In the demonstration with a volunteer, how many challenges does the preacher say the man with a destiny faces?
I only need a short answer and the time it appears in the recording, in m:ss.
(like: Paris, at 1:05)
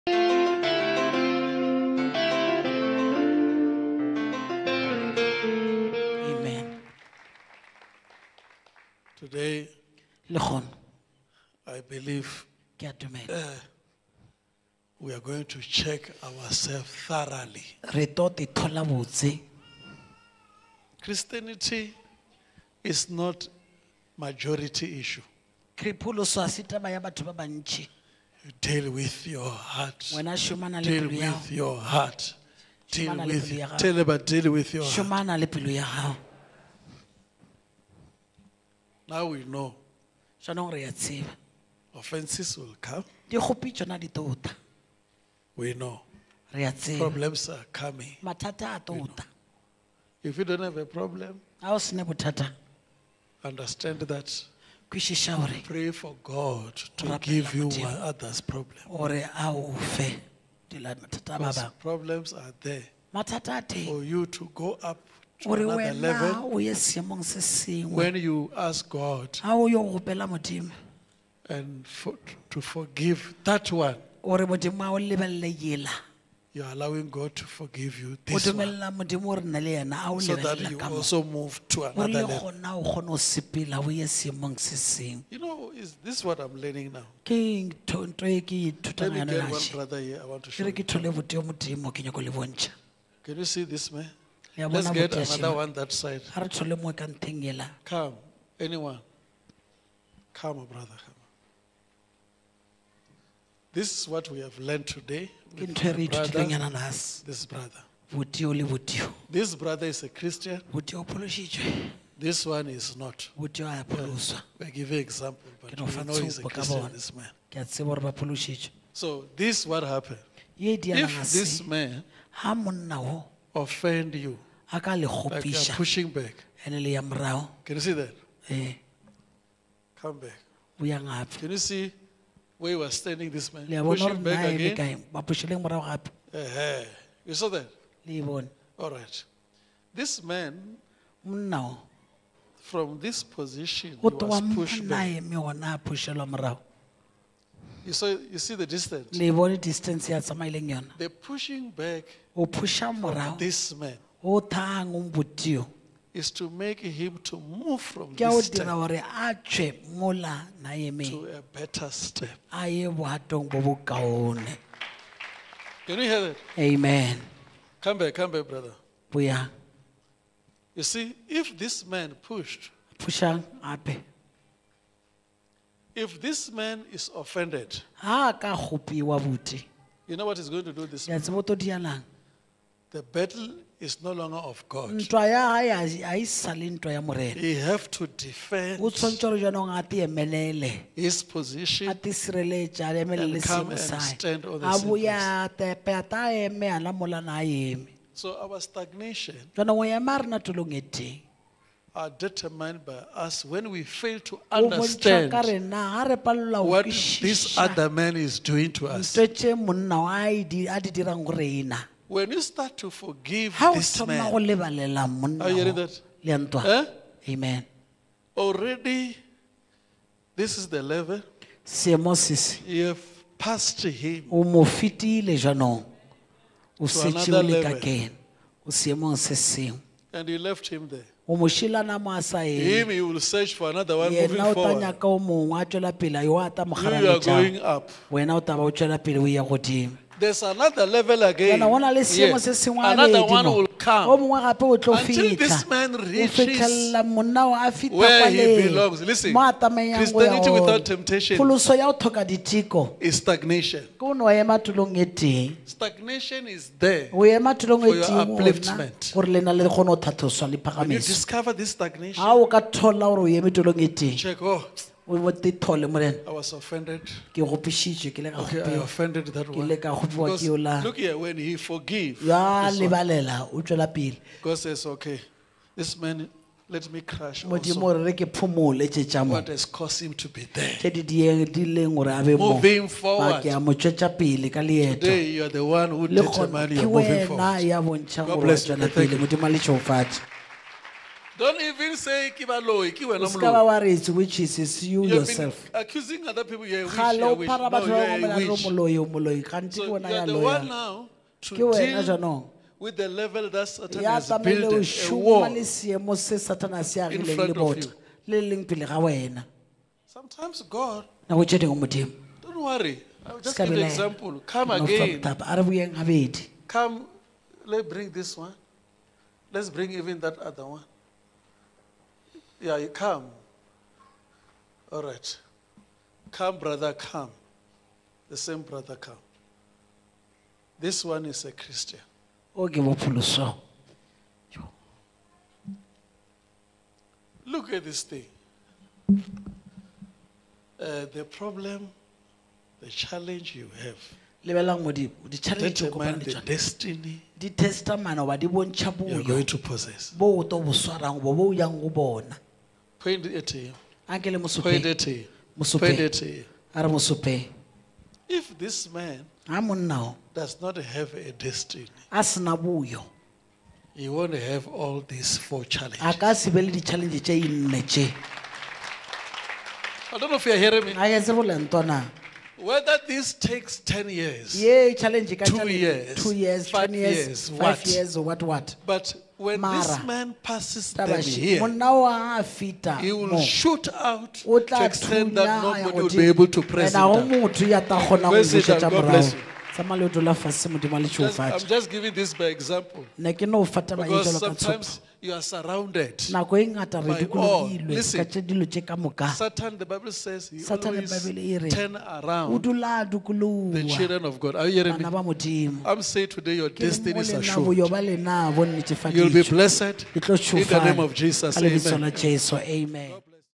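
4, at 6:04.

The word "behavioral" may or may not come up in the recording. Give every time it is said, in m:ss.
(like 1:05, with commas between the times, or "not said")
not said.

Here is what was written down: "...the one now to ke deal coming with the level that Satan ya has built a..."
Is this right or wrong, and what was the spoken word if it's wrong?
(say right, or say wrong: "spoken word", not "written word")
wrong: "jaanong", not "coming".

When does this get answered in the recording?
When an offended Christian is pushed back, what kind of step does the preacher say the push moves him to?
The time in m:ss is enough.
2:41.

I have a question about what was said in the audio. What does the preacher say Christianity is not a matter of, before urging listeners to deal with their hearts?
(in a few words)
Majority.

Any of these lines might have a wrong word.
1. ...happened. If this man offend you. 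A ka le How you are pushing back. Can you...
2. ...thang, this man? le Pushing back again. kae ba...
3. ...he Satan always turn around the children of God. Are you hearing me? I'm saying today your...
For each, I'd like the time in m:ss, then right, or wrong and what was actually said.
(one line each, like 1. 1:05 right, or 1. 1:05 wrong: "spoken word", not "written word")
1. 1:59 wrong: "Like", not "How"
2. 2:12 wrong: "standing", not "thang"
3. 6:40 right.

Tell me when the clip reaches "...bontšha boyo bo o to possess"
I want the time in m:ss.
5:48.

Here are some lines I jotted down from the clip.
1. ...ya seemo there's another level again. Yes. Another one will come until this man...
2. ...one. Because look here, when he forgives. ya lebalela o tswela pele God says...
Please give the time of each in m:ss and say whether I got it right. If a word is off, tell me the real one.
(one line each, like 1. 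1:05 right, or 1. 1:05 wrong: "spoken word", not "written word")
1. 3:59 wrong: "godimo", not "seemo"
2. 4:29 right.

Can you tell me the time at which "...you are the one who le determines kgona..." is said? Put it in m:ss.
4:45.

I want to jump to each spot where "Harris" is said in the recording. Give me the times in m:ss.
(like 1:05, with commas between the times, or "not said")
not said.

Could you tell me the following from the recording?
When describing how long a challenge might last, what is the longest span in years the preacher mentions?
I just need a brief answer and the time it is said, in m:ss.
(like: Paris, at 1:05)
10 years, at 6:13.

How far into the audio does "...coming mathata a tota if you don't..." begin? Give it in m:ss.
0:47.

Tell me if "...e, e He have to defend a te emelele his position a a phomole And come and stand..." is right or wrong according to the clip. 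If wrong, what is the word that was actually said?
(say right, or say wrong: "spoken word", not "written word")
wrong: "emelele", not "phomole".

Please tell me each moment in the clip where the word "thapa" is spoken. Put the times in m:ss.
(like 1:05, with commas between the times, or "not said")
5:15.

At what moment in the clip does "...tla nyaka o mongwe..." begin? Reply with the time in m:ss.
3:54.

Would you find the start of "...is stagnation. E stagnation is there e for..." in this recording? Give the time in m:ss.
4:12.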